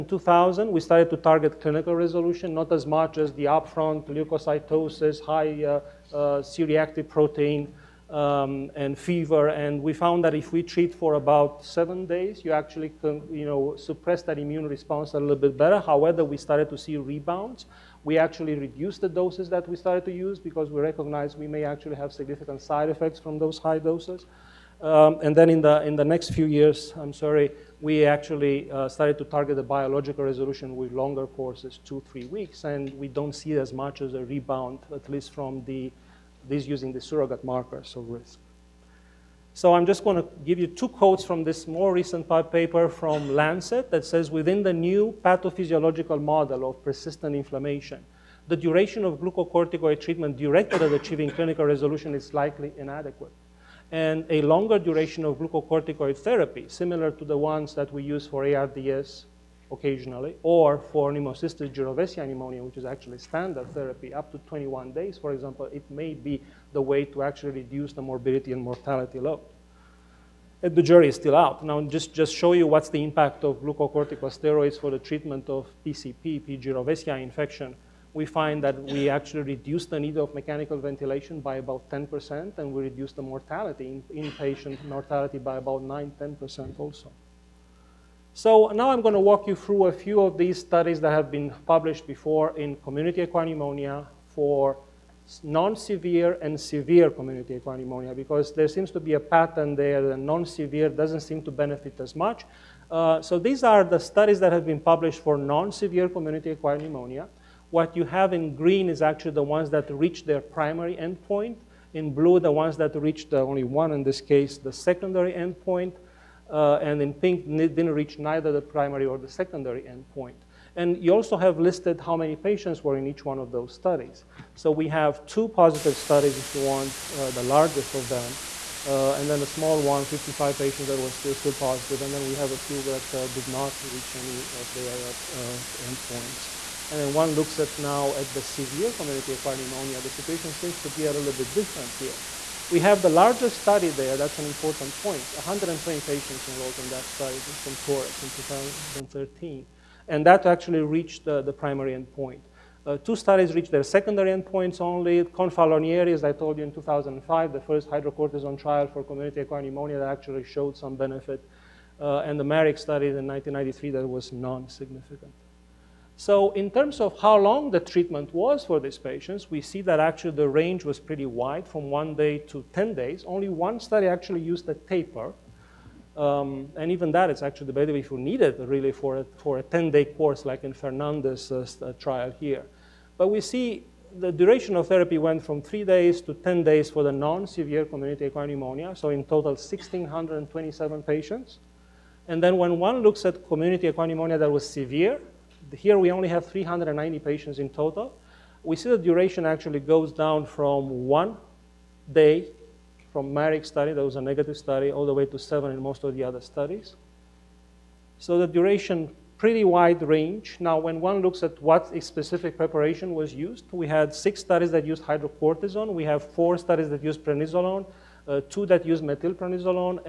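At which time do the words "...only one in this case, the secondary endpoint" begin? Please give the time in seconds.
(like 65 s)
113 s.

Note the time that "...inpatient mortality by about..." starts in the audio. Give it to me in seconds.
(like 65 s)
84 s.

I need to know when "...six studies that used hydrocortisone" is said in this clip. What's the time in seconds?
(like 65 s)
214 s.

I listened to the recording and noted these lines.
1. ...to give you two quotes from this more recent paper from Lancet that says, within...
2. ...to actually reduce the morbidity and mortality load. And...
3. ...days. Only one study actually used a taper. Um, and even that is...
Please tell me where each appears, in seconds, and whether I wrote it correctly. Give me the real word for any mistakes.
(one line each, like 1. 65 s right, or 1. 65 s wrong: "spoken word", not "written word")
1. 40 s right
2. 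67 s right
3. 172 s right.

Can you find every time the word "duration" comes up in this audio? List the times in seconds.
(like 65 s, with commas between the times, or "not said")
48 s, 54 s, 184 s, 198 s, 208 s.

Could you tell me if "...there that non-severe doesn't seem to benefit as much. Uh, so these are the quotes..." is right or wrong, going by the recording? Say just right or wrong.
wrong.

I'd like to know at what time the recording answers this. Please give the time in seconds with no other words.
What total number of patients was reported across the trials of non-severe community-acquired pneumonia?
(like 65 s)
189 s.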